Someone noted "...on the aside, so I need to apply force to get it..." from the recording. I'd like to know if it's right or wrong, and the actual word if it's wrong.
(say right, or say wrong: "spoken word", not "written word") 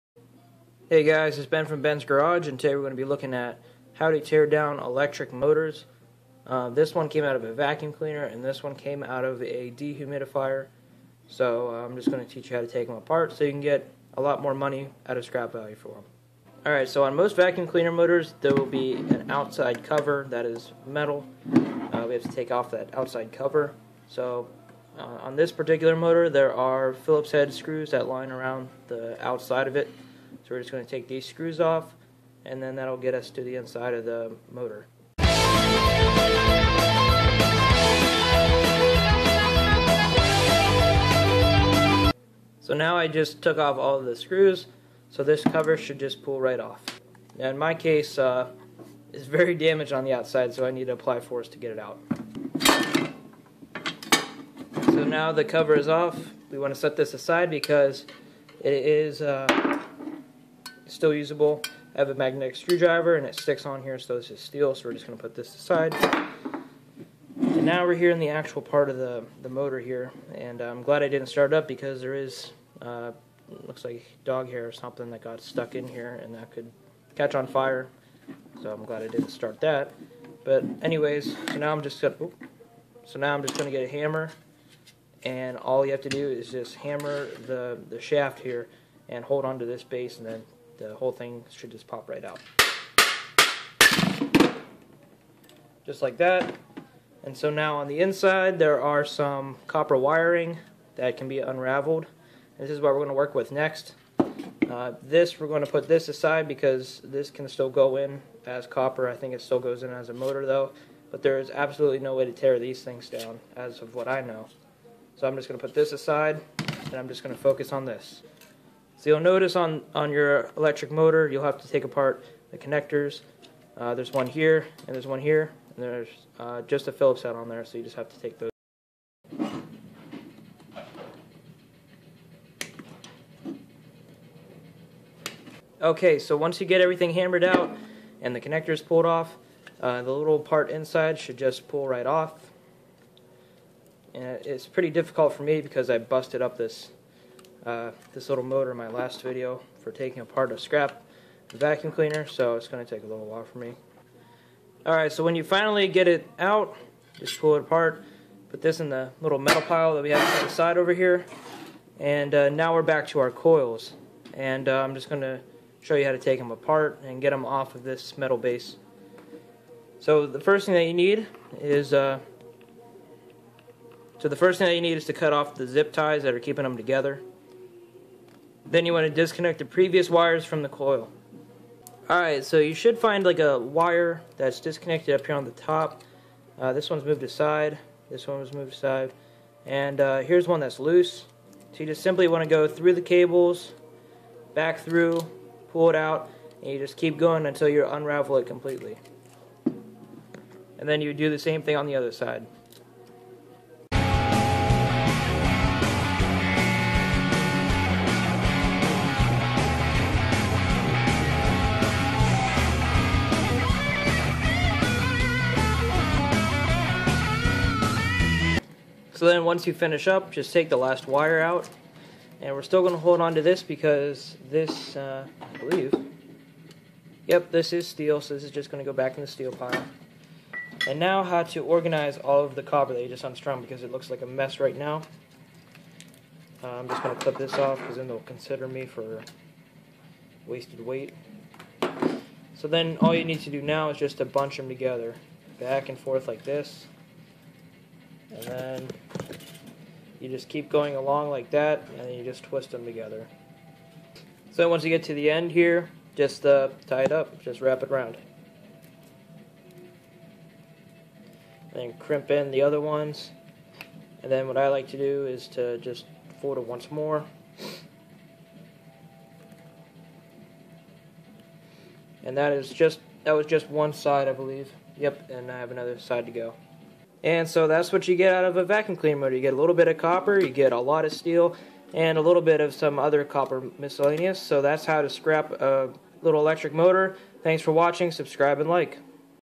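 wrong: "outside", not "aside".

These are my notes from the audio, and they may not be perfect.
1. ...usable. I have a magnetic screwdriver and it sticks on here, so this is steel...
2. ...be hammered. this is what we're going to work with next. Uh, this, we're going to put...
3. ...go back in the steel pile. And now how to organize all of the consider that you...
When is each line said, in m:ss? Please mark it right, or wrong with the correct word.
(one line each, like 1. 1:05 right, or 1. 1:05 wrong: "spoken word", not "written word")
1. 1:01 right
2. 1:41 wrong: "unraveled", not "hammered"
3. 3:48 wrong: "copper", not "consider".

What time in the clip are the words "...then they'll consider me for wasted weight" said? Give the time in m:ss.
3:57.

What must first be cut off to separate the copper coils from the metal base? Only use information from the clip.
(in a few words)
Zip ties.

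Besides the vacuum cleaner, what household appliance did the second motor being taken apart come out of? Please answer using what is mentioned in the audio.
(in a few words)
Dehumidifier.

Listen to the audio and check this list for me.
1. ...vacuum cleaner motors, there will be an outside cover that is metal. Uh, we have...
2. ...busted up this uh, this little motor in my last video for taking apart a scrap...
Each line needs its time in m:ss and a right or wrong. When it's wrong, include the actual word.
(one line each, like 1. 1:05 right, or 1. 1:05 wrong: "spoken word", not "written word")
1. 0:17 right
2. 2:25 right.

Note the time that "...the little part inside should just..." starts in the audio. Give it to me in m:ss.
2:20.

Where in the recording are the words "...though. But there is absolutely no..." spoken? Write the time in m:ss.
1:50.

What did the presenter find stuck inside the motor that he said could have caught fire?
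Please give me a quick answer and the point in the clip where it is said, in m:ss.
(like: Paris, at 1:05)
Dog hair, at 1:14.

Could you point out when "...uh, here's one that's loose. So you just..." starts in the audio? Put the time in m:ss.
3:09.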